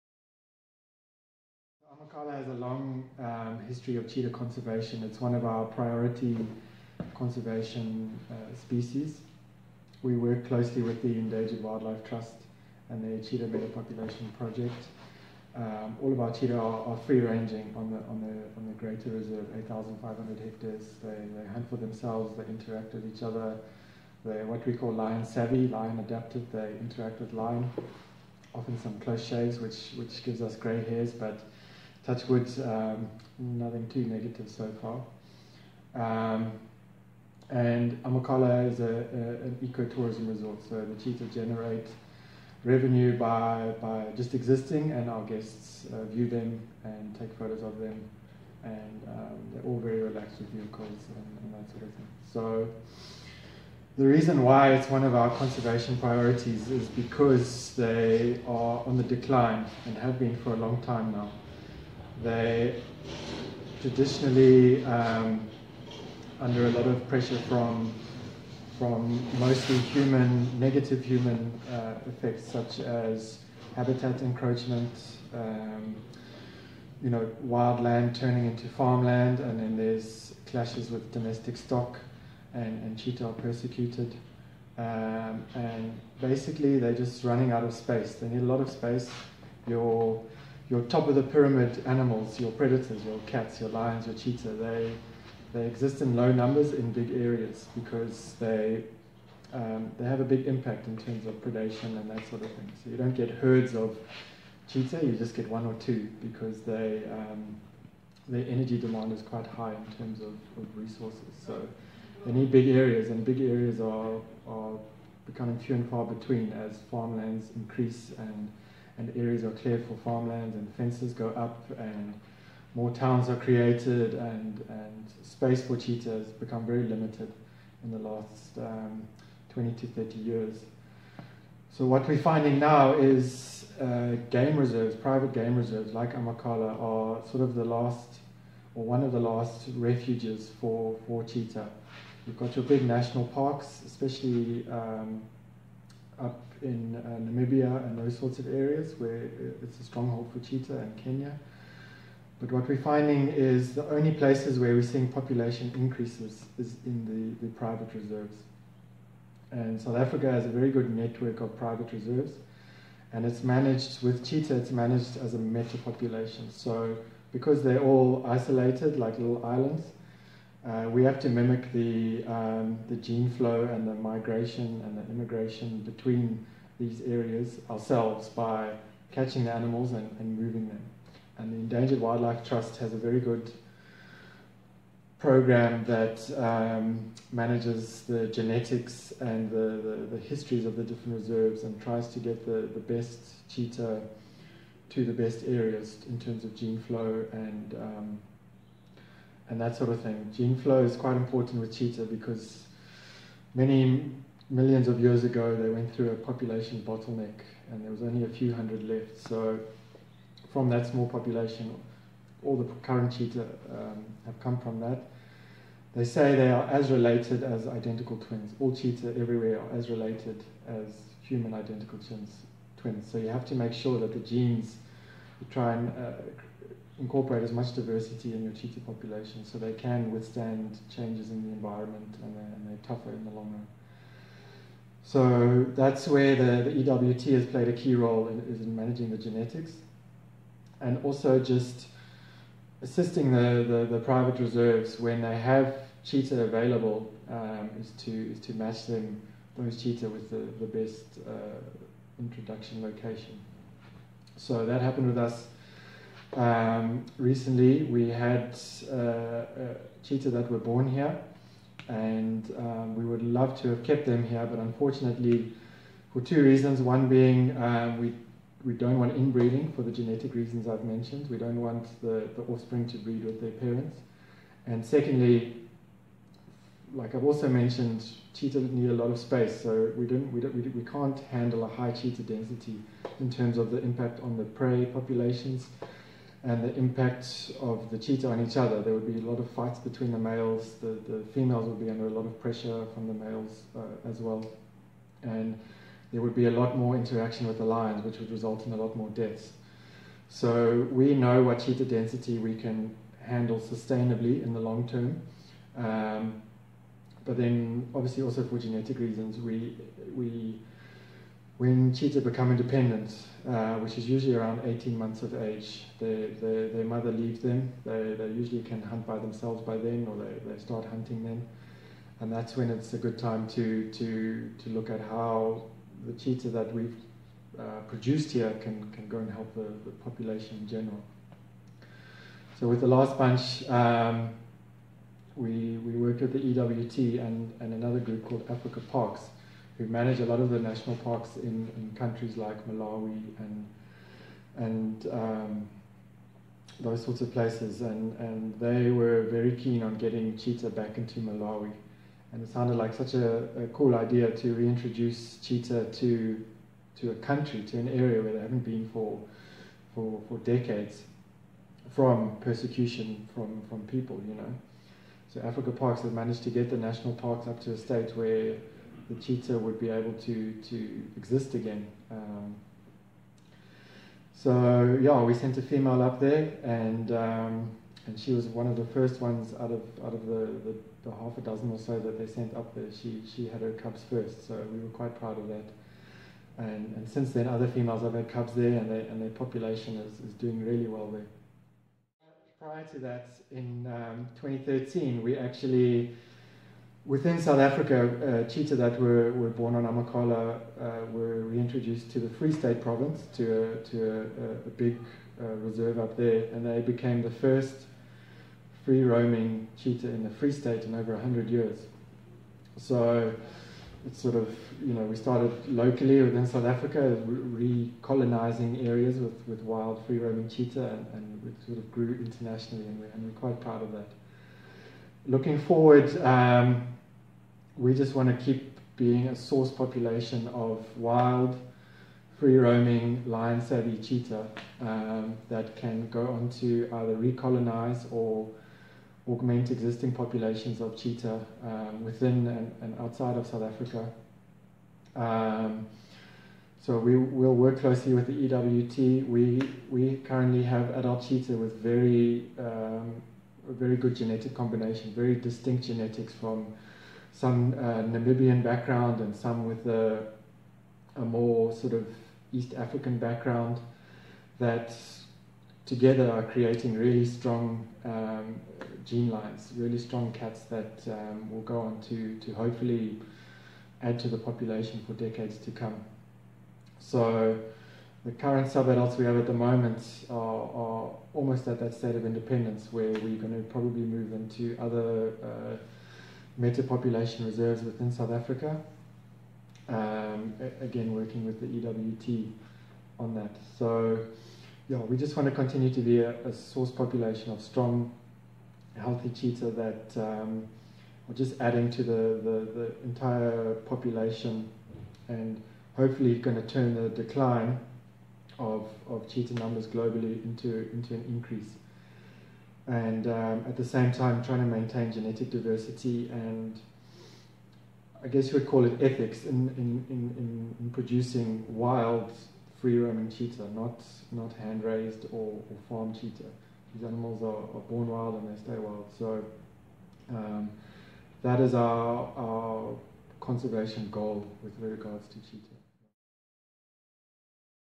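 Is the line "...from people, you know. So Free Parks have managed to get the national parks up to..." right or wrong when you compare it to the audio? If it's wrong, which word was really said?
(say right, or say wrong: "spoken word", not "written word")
wrong: "Africa", not "Free".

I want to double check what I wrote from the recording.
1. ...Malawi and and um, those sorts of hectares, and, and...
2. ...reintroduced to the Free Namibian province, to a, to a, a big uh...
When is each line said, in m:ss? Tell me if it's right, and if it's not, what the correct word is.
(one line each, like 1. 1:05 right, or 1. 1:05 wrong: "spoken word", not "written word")
1. 5:42 wrong: "places", not "hectares"
2. 6:41 wrong: "State", not "Namibian".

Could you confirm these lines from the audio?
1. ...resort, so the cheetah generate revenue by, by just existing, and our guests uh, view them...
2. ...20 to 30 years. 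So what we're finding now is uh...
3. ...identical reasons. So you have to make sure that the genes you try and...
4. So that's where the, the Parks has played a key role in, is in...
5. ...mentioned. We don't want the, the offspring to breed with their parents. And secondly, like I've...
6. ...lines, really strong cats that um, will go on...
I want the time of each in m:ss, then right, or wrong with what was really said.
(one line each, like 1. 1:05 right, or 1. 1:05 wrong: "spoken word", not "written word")
1. 0:40 right
2. 2:09 right
3. 3:41 wrong: "twins", not "reasons"
4. 3:55 wrong: "EWT", not "Parks"
5. 4:30 right
6. 7:49 right.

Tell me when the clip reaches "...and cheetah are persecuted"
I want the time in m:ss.
1:22.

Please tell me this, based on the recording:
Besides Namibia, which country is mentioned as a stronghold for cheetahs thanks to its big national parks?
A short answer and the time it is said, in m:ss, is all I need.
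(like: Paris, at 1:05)
Kenya, at 2:30.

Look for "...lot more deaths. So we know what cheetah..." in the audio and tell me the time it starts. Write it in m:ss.
4:58.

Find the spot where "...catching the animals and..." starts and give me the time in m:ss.
2:59.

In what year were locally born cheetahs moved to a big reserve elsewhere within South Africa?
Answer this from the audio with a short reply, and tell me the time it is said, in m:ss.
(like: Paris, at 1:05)
2013, at 6:34.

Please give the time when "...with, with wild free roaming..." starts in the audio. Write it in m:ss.
6:59.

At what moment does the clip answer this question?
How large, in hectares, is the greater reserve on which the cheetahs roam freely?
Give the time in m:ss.
0:19.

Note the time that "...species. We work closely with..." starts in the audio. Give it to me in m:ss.
0:08.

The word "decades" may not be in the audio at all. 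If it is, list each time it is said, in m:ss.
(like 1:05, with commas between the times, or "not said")
6:00, 7:55.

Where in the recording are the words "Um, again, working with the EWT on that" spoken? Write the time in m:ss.
8:09.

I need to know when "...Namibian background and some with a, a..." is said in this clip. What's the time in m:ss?
7:38.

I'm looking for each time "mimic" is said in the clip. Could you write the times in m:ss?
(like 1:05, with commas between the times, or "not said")
2:51.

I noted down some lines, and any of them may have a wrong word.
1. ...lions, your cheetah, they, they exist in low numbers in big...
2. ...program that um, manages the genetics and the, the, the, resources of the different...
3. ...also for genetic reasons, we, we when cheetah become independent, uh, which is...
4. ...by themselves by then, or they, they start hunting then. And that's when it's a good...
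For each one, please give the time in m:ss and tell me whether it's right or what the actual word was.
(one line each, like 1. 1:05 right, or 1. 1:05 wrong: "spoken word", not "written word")
1. 1:33 right
2. 3:05 wrong: "histories", not "resources"
3. 5:08 right
4. 5:19 right.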